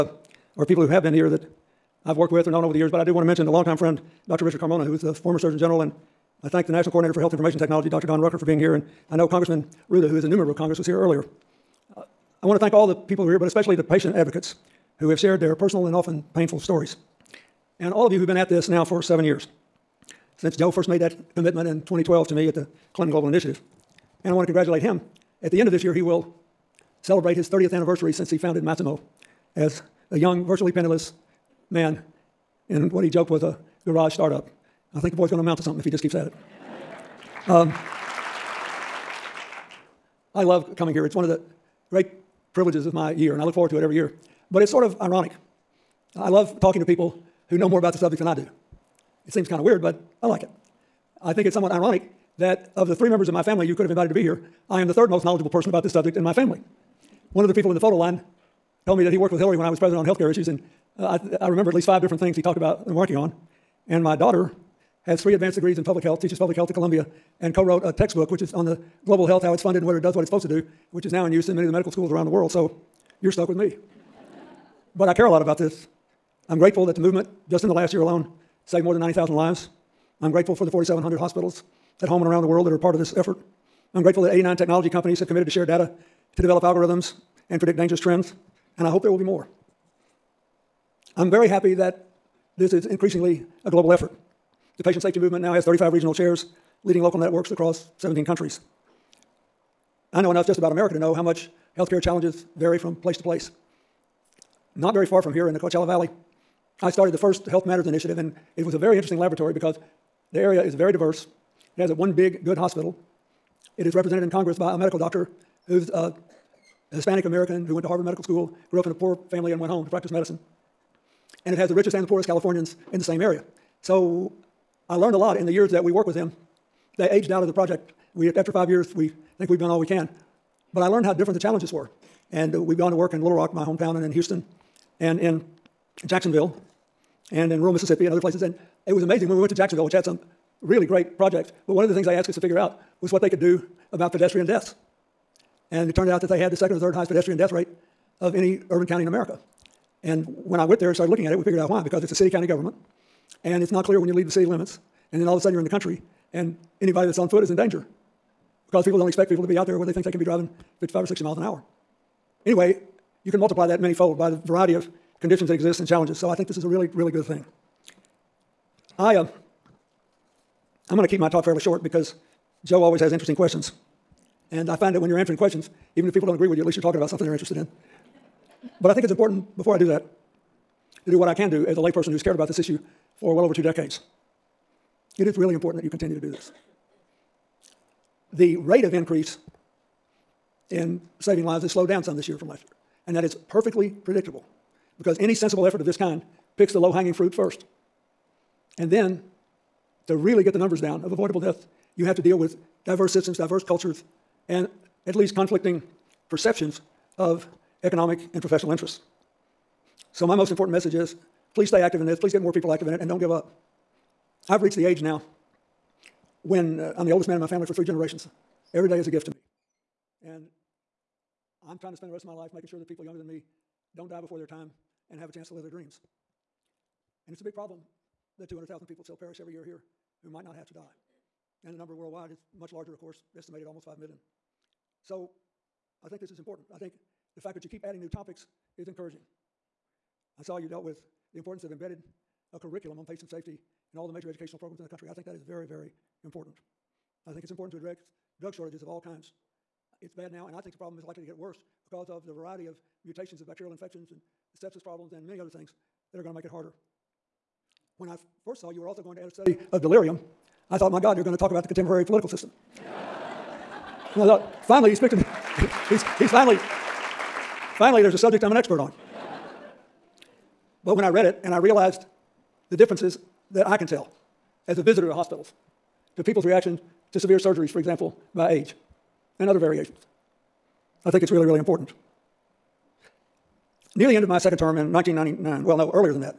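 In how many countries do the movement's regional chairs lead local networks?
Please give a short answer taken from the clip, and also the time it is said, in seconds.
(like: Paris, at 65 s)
17, at 97 s.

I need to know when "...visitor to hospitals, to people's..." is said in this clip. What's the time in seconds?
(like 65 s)
274 s.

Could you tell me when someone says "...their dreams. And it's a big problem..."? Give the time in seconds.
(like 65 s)
225 s.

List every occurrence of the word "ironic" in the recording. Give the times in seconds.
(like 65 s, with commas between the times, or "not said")
44 s, 51 s.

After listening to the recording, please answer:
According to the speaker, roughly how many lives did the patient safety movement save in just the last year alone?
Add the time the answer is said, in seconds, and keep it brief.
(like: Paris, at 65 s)
90,000, at 79 s.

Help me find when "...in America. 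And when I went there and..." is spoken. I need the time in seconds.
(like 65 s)
149 s.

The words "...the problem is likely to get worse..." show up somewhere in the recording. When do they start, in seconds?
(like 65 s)
250 s.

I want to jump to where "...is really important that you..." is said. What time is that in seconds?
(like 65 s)
185 s.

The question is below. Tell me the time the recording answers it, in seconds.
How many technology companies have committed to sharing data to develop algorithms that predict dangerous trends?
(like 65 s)
84 s.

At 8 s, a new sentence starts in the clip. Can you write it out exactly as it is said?
Don Rucker, for being here, and I know Congressman.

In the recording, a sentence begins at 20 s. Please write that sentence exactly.
Since Joe first made that commitment in 2012 to me at the Clinton Global Initiative.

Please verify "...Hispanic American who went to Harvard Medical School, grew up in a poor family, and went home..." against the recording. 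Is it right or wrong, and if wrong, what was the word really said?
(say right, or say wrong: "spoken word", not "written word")
right.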